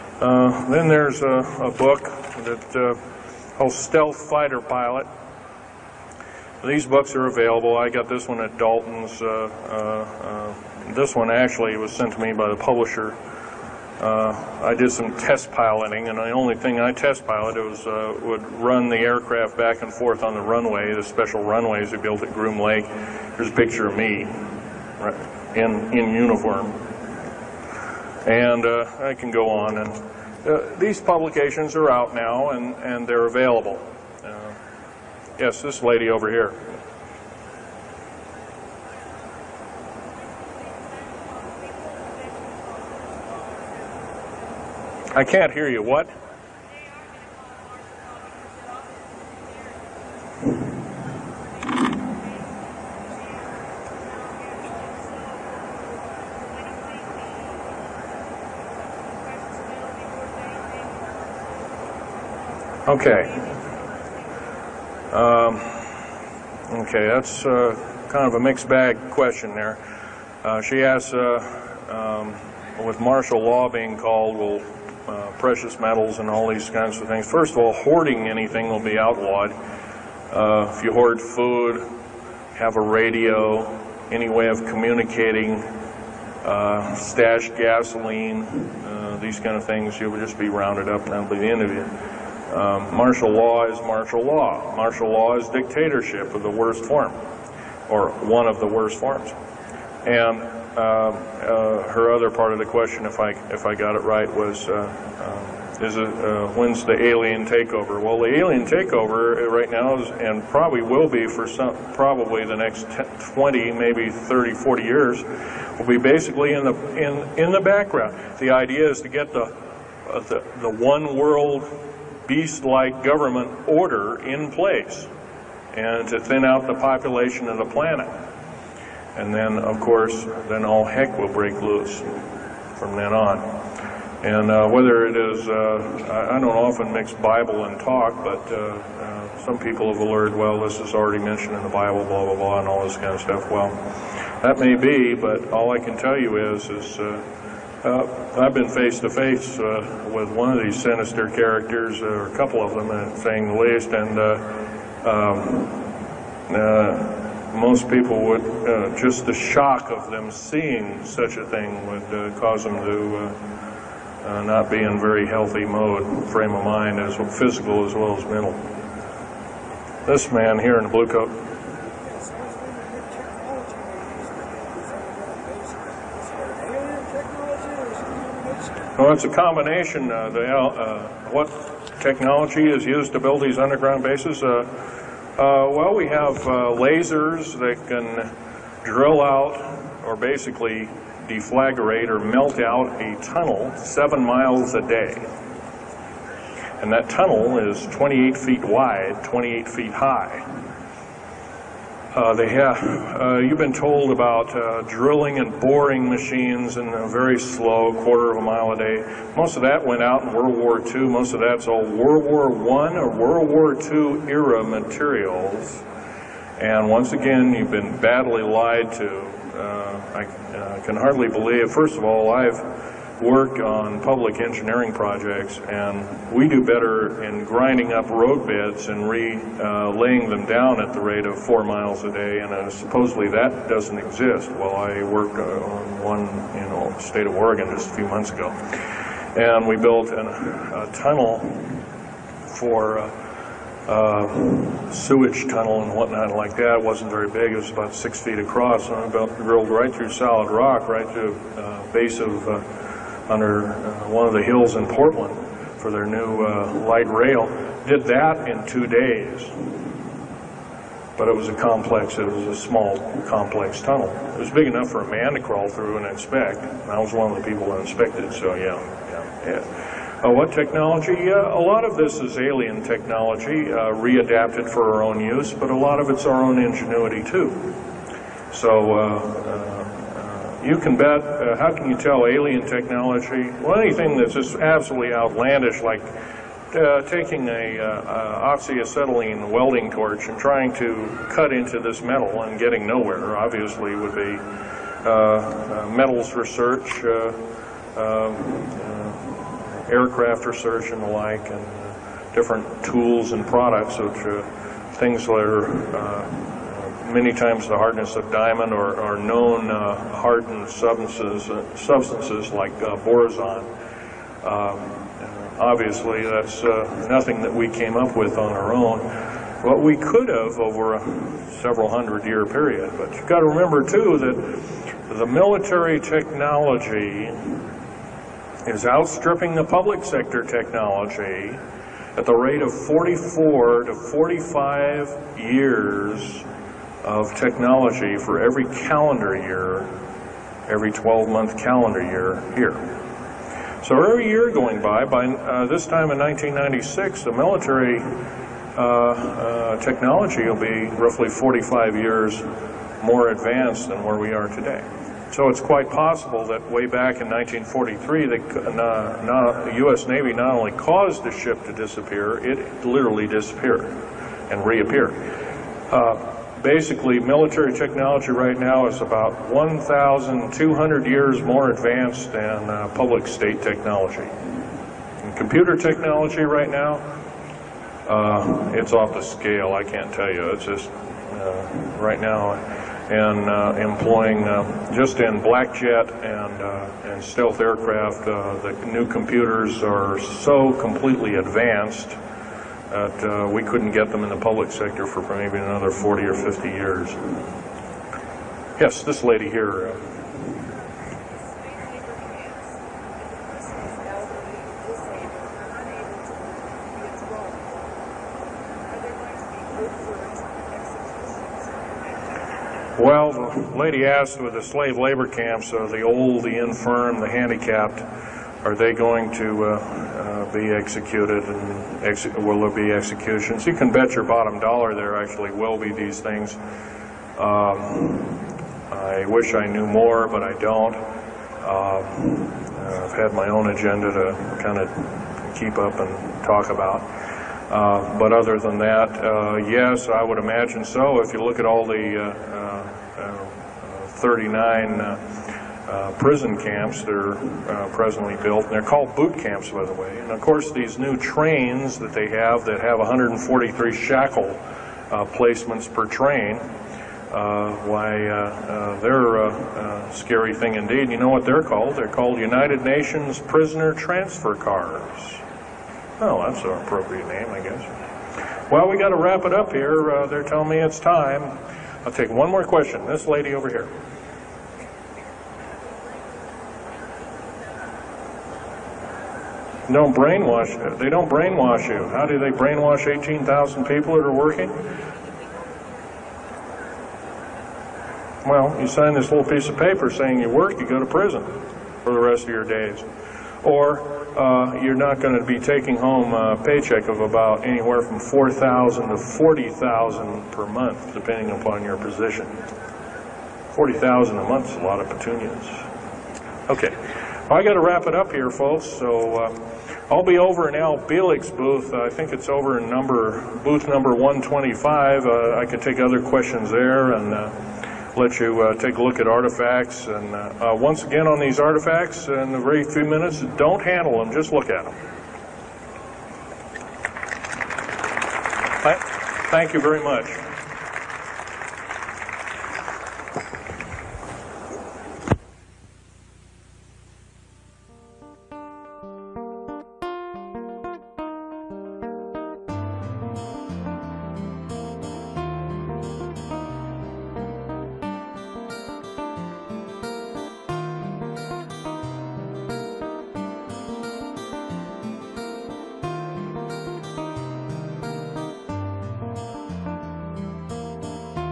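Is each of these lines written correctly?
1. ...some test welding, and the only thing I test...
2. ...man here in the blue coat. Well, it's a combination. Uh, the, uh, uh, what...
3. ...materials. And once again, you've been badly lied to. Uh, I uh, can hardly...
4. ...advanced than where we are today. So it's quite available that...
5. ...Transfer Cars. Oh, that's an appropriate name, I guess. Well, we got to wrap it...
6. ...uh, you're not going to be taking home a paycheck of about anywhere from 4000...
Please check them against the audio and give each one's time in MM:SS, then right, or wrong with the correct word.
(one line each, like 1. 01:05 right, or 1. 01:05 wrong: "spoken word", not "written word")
1. 00:14 wrong: "piloting", not "welding"
2. 02:50 right
3. 03:34 right
4. 05:53 wrong: "possible", not "available"
5. 07:43 right
6. 08:14 right.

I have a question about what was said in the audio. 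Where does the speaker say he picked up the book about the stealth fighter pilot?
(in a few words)
Dalton's.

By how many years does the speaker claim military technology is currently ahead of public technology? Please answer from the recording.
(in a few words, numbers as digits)
1,200 years.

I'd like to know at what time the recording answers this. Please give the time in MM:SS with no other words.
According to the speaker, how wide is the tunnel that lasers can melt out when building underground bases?
03:17.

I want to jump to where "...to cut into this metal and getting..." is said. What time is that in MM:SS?
04:50.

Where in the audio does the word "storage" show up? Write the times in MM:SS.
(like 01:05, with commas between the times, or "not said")
not said.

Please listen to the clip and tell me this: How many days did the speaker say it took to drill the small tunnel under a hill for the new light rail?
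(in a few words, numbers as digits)
2 days.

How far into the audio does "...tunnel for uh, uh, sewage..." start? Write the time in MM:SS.
04:00.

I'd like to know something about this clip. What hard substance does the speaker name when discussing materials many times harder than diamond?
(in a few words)
borazon.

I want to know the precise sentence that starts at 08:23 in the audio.
40000 a month is a lot of petunias.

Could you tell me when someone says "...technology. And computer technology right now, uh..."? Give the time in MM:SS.
06:13.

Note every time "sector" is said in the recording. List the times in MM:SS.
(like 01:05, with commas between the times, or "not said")
05:30, 06:34.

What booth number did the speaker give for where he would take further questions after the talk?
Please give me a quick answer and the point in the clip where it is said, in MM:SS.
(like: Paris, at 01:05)
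125, at 08:34.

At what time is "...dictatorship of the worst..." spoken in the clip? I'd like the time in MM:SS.
01:35.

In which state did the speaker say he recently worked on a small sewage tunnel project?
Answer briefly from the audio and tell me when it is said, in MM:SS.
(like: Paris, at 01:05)
Oregon, at 03:57.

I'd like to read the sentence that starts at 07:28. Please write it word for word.
And they're called boot camps, by the way.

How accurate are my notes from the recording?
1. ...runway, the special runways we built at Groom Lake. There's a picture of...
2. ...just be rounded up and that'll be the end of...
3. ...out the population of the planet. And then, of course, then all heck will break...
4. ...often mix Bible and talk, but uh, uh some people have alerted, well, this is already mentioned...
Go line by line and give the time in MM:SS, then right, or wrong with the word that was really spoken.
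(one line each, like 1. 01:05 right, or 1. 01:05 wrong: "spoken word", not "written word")
1. 00:20 right
2. 01:30 right
3. 02:06 right
4. 02:16 right.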